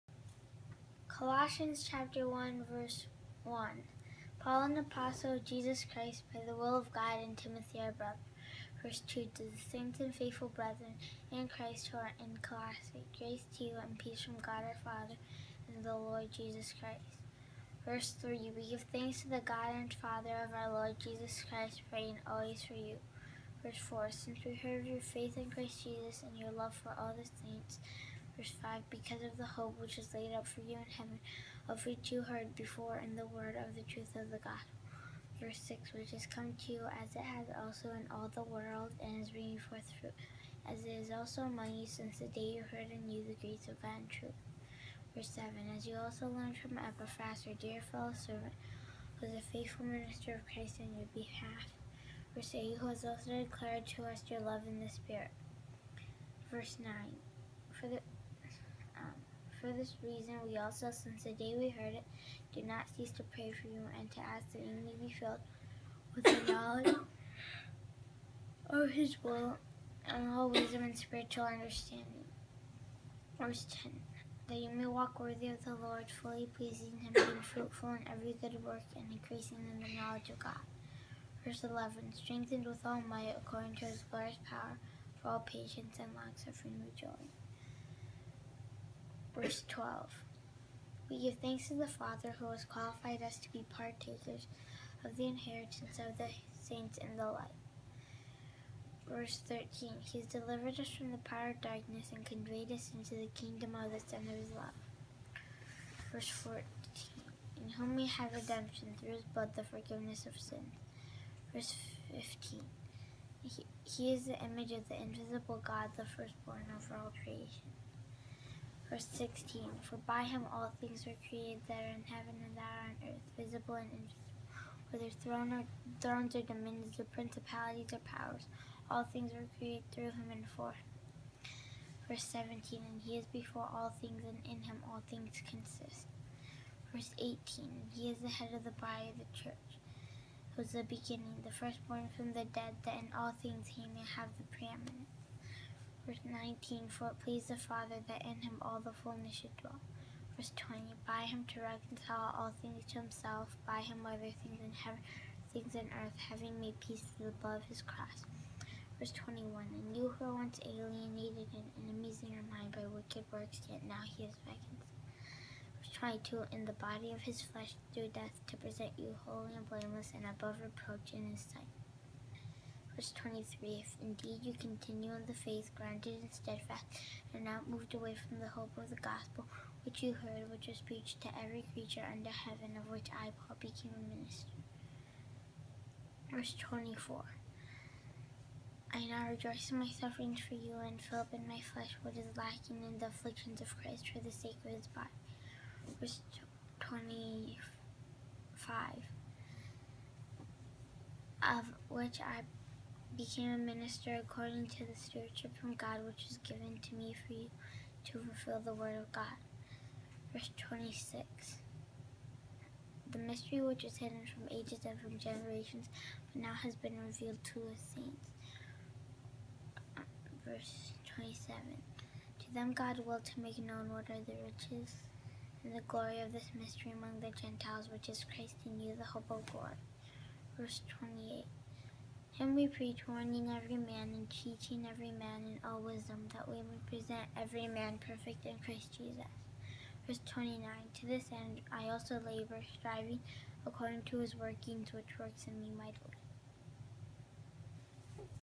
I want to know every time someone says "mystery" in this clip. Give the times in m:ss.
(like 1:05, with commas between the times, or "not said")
3:33, 3:46.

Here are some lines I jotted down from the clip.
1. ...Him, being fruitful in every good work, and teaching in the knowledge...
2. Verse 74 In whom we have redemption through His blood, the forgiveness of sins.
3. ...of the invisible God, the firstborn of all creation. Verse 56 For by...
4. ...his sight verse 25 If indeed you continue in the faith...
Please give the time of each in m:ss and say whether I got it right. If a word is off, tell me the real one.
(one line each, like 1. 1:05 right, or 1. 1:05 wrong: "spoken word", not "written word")
1. 1:16 wrong: "increasing", not "teaching"
2. 1:46 wrong: "14", not "74"
3. 1:54 wrong: "16", not "56"
4. 2:51 wrong: "23", not "25".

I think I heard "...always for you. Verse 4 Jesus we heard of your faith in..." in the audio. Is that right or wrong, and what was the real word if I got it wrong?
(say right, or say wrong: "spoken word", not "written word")
wrong: "Since", not "Jesus".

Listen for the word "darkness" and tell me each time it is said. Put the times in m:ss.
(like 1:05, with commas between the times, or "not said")
1:41.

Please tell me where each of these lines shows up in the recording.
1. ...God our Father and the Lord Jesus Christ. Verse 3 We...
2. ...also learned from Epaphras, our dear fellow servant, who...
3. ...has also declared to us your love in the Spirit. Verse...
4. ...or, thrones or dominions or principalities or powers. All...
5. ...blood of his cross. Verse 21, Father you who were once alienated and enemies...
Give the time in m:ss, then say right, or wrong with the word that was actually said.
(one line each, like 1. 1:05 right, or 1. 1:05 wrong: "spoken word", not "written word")
1. 0:14 right
2. 0:45 right
3. 0:52 right
4. 2:05 right
5. 2:37 wrong: "And", not "Father".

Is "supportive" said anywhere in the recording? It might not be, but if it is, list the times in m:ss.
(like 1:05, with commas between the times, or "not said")
not said.